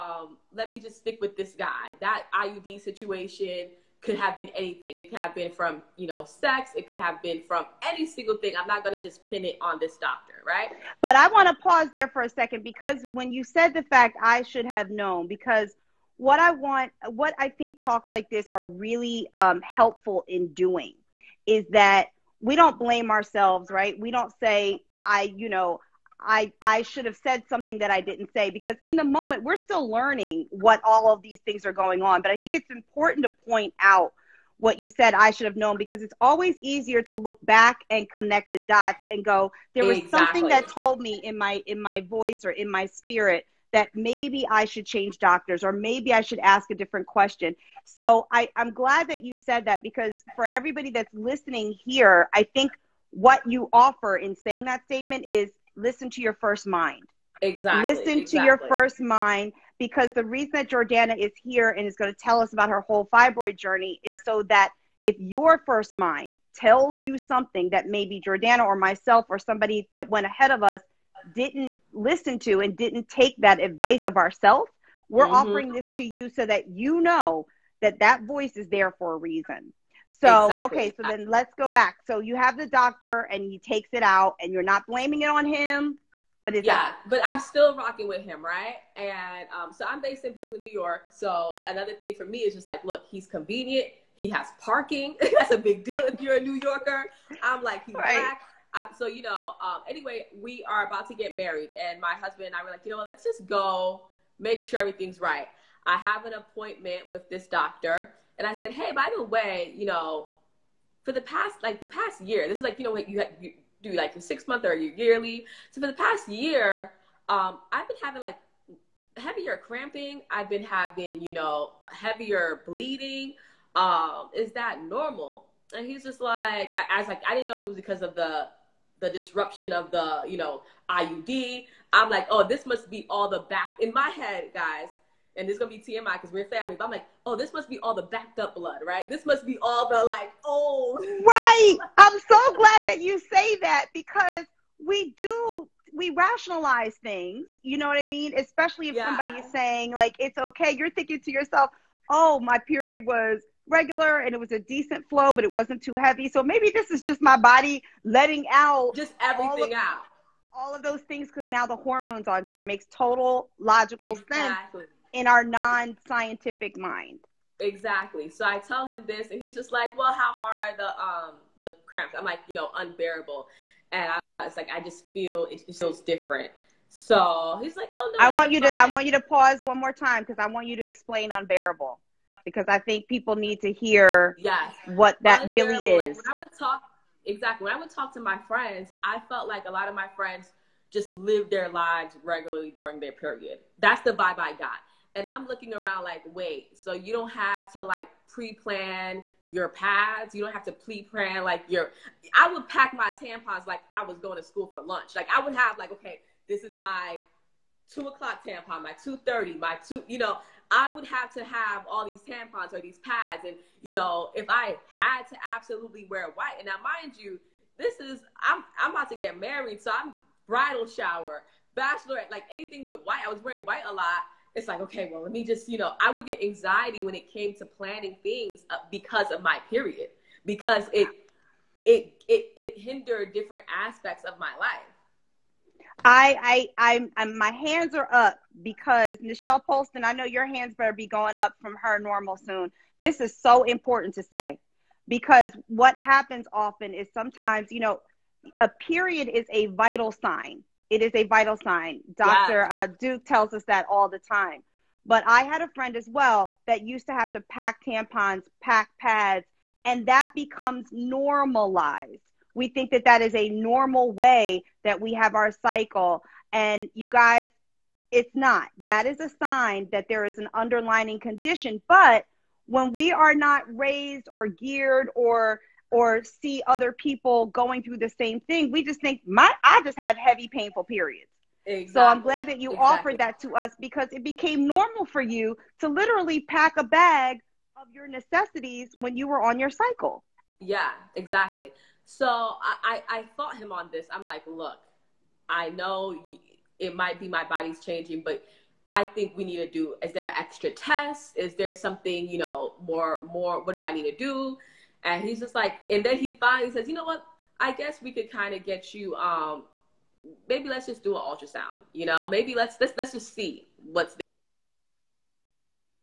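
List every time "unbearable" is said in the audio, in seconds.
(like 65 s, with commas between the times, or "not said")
172 s, 181 s.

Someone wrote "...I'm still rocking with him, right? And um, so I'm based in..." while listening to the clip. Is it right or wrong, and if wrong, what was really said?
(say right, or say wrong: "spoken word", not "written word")
right.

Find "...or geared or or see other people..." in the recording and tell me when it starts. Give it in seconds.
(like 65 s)
274 s.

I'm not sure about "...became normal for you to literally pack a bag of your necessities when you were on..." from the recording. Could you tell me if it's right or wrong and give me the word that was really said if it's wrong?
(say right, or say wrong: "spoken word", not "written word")
right.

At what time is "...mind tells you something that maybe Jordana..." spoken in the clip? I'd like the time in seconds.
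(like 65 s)
65 s.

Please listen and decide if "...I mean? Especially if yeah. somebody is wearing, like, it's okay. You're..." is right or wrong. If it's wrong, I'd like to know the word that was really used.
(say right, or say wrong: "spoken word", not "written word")
wrong: "saying", not "wearing".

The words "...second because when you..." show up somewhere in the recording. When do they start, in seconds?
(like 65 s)
12 s.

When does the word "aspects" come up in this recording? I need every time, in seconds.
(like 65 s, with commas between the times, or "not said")
233 s.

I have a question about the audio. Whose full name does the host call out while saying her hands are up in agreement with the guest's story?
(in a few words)
Nichelle Polston.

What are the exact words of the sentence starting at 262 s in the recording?
We think that that is a normal way that we have our cycle.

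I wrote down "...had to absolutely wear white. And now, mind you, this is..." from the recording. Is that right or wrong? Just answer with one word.
right.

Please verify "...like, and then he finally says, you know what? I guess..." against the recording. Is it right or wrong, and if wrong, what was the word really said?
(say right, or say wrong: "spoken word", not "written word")
right.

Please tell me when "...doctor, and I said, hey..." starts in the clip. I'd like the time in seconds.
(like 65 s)
107 s.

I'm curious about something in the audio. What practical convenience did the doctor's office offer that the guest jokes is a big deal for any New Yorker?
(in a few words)
Parking.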